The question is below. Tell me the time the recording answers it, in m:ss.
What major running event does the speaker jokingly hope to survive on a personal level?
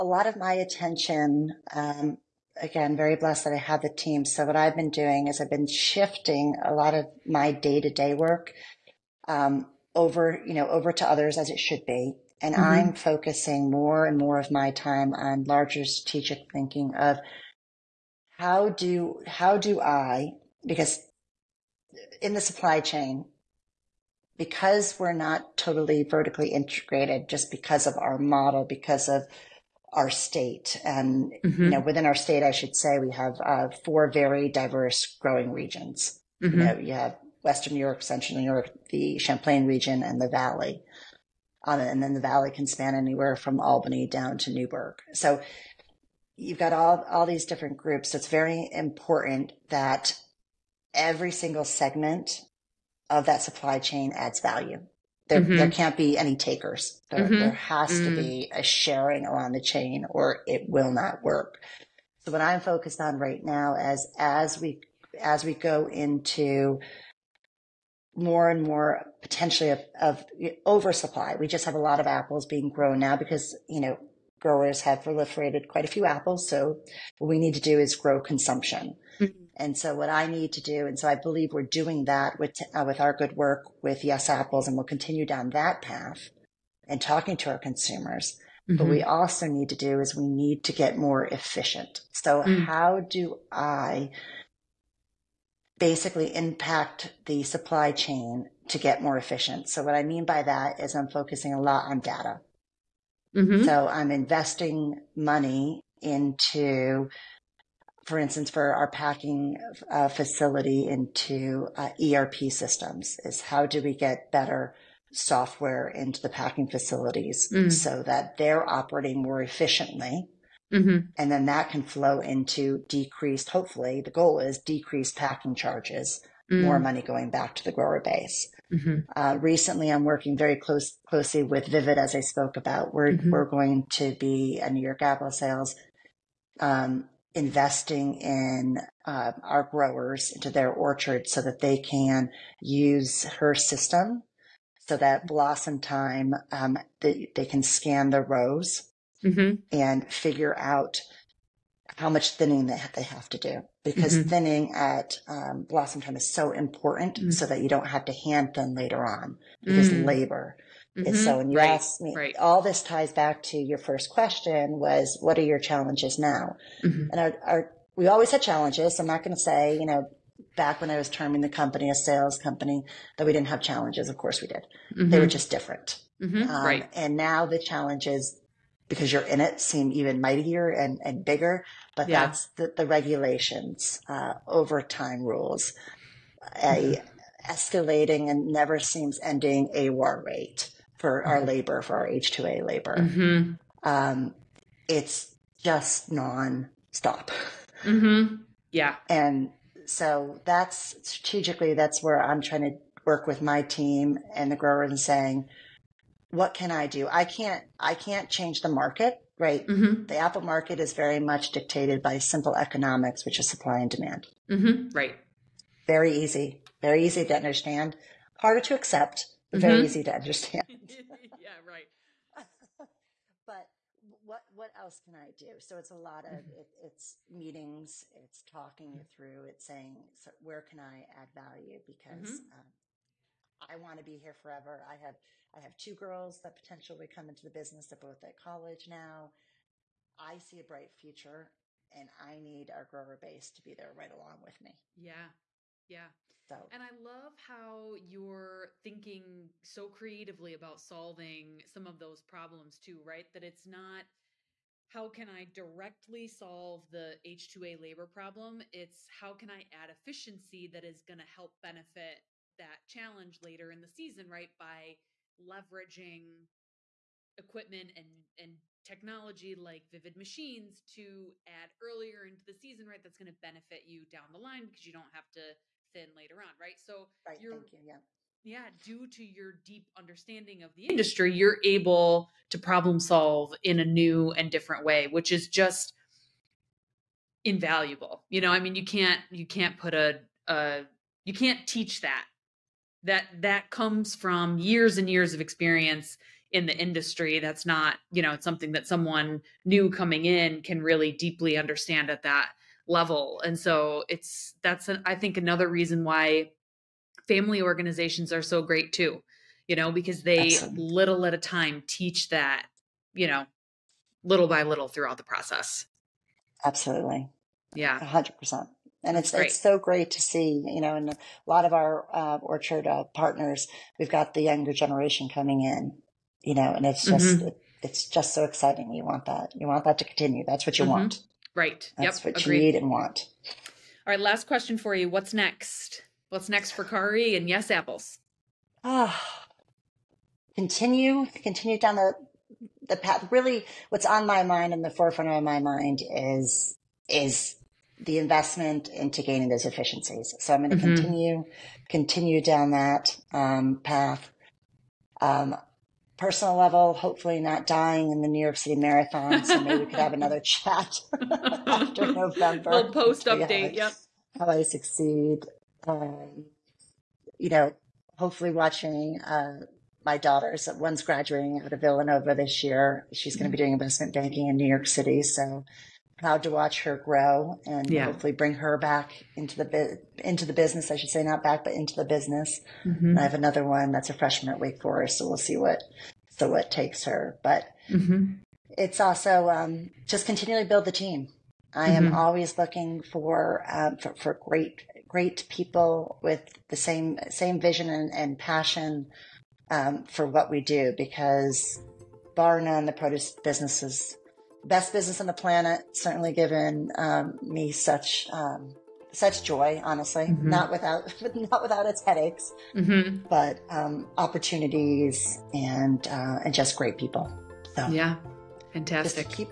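5:58.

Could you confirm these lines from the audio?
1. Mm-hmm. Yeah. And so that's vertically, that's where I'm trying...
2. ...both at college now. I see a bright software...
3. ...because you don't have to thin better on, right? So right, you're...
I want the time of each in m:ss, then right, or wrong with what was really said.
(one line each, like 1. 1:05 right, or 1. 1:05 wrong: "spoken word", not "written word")
1. 3:17 wrong: "strategically", not "vertically"
2. 3:57 wrong: "future", not "software"
3. 4:34 wrong: "later", not "better".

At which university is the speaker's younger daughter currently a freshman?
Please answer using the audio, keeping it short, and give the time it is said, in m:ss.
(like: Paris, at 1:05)
Wake Forest, at 6:24.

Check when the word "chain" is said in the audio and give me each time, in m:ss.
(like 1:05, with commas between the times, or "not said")
0:22, 0:53, 0:59, 1:37.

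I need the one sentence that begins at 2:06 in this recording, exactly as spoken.
money going back to the grower base.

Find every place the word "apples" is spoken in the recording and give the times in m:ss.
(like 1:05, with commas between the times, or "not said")
1:12, 1:16, 1:24, 2:15, 3:30, 5:37.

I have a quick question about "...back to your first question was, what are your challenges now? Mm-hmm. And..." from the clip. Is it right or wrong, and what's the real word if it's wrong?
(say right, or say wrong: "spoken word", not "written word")
right.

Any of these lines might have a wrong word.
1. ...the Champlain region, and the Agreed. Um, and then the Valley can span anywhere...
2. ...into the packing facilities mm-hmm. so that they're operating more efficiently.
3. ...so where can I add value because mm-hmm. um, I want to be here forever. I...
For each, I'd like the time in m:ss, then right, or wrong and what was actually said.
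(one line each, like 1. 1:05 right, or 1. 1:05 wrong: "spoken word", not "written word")
1. 0:38 wrong: "Valley", not "Agreed"
2. 1:55 right
3. 3:50 right.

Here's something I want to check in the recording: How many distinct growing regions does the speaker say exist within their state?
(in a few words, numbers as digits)
4.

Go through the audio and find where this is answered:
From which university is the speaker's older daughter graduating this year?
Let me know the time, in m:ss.
6:11.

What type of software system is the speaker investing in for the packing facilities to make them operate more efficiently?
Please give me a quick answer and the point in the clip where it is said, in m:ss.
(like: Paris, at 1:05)
ERP systems, at 1:52.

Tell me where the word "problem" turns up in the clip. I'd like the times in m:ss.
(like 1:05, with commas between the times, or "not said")
4:12, 4:18, 4:42.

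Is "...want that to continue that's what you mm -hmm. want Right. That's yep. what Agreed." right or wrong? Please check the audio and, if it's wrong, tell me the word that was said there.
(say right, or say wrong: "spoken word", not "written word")
right.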